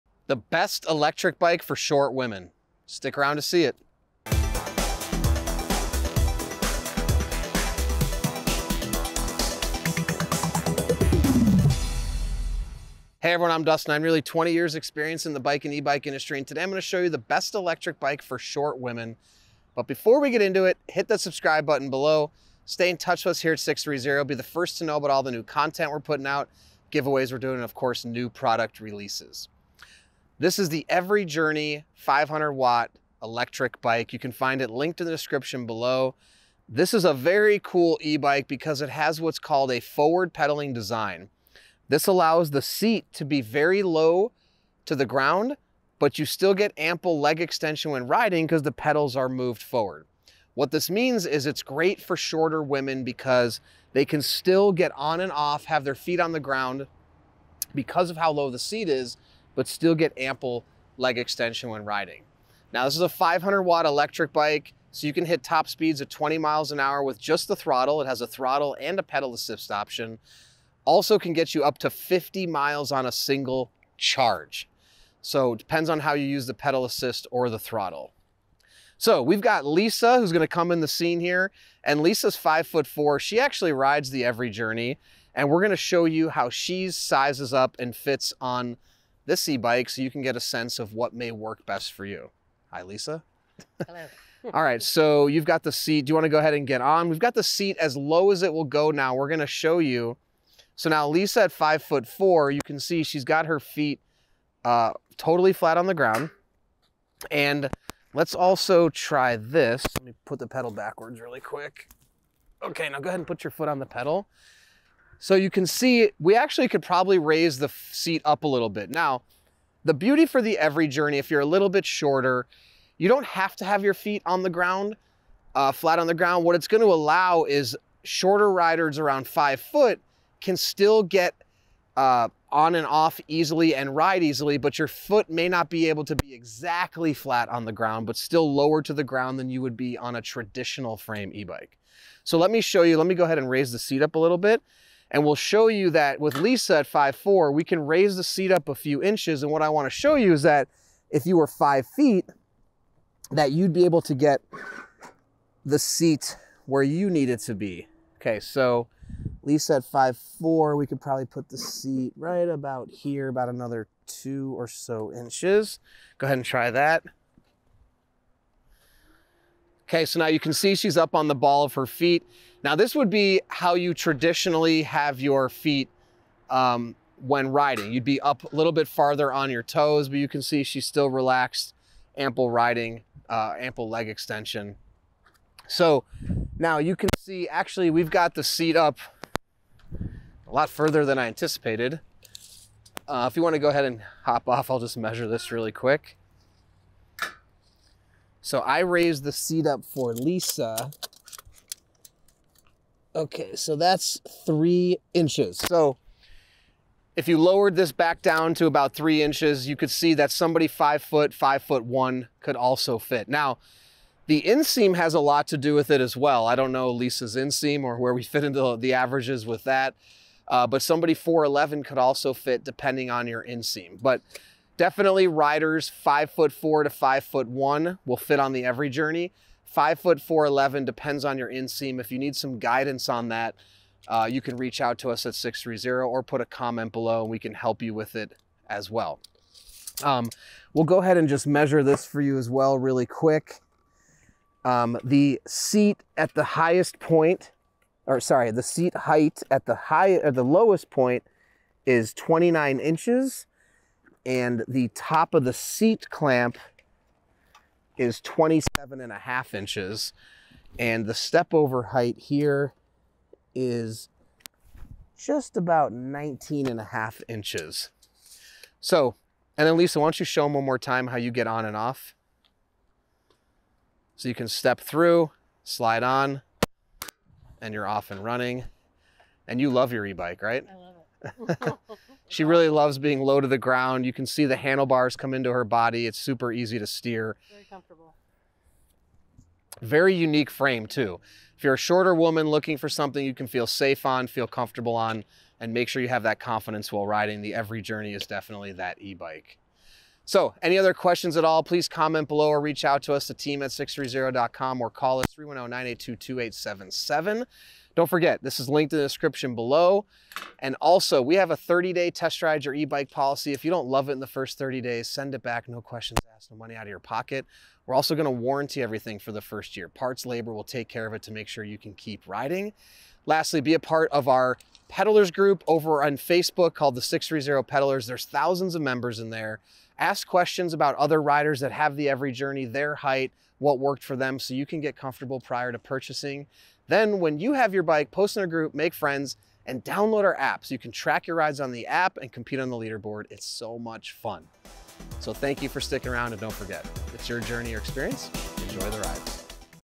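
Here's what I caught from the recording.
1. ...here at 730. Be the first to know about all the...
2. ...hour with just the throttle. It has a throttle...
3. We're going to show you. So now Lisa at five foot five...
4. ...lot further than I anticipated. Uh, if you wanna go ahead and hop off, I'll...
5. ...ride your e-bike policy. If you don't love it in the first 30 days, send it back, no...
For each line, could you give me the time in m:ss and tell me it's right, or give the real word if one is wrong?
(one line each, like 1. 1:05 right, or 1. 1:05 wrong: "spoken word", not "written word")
1. 0:23 wrong: "630", not "730"
2. 1:06 right
3. 1:39 wrong: "four", not "five"
4. 3:10 right
5. 5:12 right.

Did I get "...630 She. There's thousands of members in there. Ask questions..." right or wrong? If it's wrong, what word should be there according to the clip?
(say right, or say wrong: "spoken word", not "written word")
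wrong: "Pedalers", not "She".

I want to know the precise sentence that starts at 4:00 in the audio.
Um, we'll go ahead and just measure this for you as well really quick.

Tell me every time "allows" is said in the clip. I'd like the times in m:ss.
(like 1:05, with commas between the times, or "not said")
0:42, 2:06.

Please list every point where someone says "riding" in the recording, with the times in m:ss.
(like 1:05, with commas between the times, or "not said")
0:48, 1:01, 2:57, 3:02, 4:57, 5:22.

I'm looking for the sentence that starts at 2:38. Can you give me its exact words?
Okay, so Lisa at 5'4", we could probably put the seat right about here, about another two or so inches.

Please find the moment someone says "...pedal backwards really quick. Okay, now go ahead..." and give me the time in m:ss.
1:50.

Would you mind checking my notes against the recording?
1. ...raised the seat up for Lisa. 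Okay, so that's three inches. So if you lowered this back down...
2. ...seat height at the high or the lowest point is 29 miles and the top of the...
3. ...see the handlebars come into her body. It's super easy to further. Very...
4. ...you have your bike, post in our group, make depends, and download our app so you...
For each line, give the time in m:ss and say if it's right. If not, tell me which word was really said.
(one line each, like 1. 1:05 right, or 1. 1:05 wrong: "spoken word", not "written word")
1. 3:18 right
2. 4:08 wrong: "inches", not "miles"
3. 4:44 wrong: "steer", not "further"
4. 5:37 wrong: "friends", not "depends".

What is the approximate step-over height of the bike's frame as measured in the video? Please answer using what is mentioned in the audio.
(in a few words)
19.5 inches.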